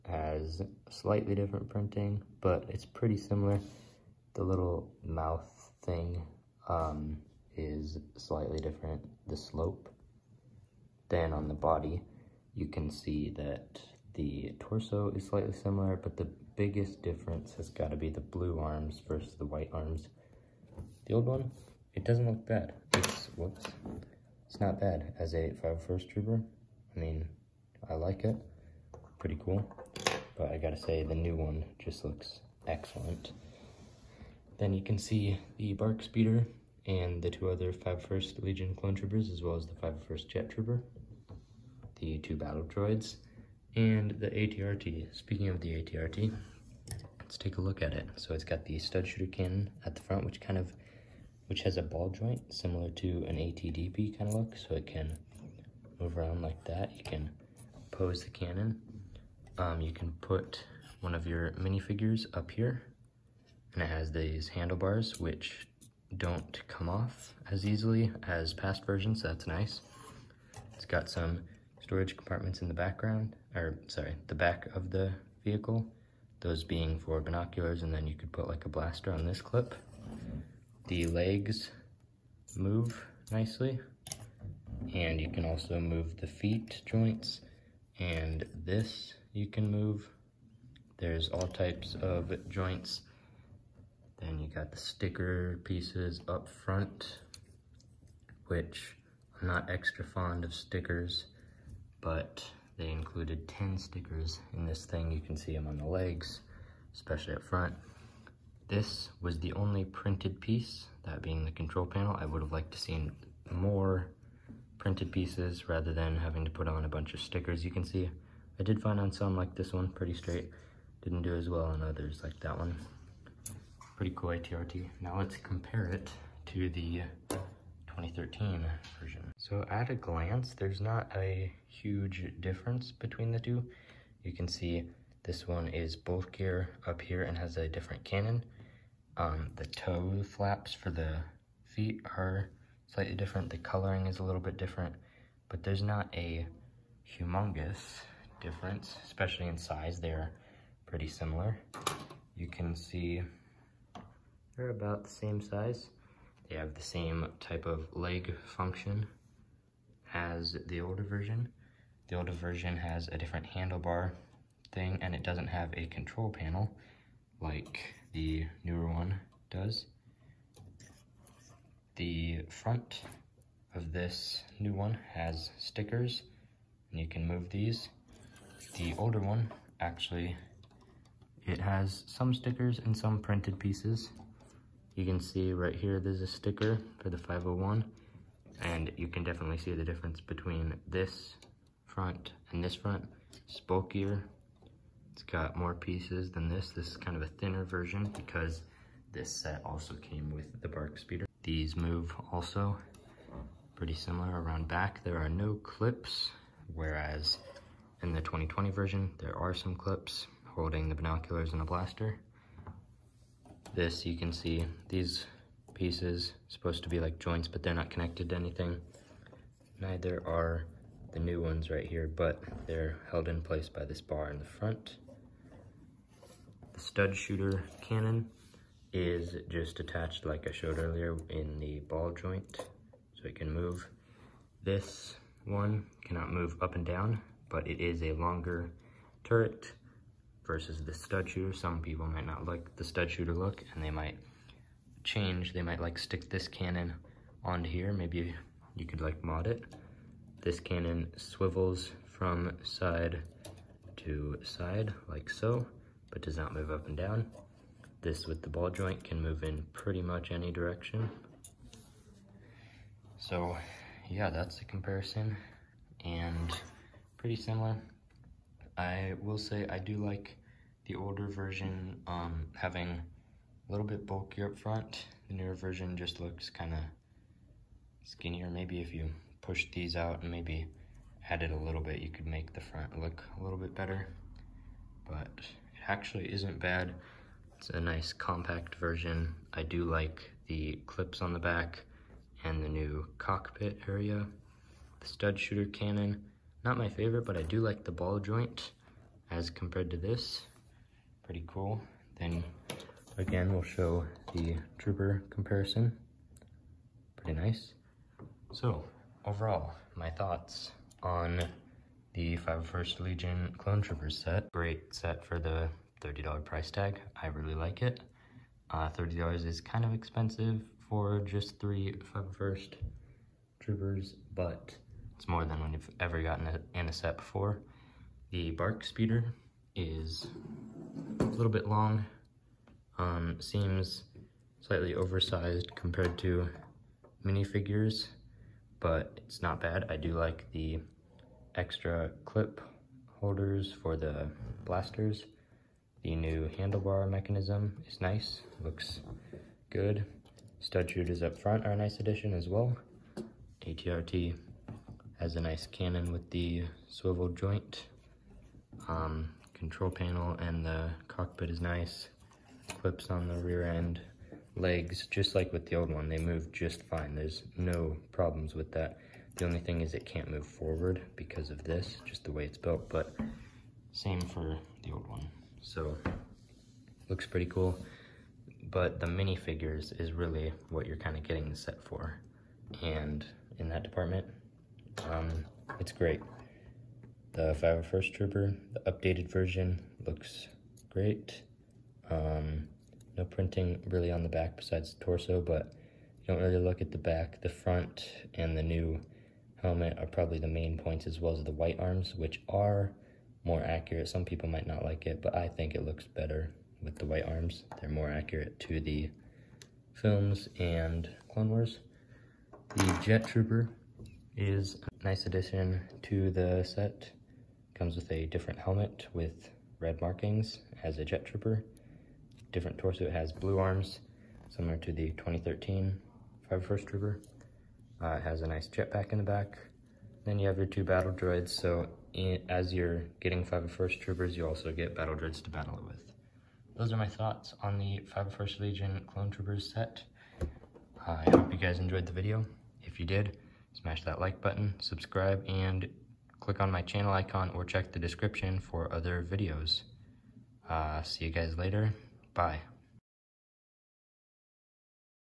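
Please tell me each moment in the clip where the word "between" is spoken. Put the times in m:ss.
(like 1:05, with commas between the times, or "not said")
2:12, 3:10.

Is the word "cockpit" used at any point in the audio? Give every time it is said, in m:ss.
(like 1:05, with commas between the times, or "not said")
4:53, 6:01.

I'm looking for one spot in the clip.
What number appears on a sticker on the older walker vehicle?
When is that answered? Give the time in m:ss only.
3:07.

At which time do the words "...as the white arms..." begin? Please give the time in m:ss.
6:41.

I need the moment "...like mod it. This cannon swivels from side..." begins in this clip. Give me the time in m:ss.
4:08.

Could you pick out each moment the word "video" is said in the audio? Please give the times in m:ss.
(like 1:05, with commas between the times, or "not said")
7:22, 7:29.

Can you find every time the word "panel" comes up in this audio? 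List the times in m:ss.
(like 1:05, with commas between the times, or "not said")
1:51, 2:46, 5:59.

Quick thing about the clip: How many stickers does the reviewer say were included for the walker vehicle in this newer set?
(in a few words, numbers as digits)
10.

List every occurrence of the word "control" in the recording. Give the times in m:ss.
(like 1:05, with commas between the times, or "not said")
1:51, 2:45, 5:59.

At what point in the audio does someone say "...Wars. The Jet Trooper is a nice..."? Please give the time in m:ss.
6:51.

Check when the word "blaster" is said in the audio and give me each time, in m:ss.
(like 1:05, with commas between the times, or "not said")
1:18, 3:31, 5:44.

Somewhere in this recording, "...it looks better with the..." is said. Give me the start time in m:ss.
6:45.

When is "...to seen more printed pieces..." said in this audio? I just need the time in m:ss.
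1:52.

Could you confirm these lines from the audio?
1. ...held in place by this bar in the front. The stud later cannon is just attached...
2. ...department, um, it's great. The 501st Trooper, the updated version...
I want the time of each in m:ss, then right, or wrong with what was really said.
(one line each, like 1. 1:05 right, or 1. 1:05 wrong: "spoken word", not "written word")
1. 3:43 wrong: "shooter", not "later"
2. 6:23 right.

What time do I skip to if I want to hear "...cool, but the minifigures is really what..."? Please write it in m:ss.
6:17.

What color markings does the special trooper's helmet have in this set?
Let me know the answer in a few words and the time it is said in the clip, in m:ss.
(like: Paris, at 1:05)
Red, at 6:59.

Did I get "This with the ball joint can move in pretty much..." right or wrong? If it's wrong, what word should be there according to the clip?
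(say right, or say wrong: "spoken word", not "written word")
right.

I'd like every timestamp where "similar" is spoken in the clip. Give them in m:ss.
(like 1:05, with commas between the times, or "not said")
0:03, 0:15, 0:52, 2:31, 3:23, 4:27, 7:04.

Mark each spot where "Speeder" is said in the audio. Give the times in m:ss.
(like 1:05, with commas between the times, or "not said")
0:36, 3:20, 5:28.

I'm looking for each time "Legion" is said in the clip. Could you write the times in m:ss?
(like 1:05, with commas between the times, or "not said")
0:38, 5:13, 7:18.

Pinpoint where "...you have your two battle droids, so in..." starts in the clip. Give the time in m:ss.
7:10.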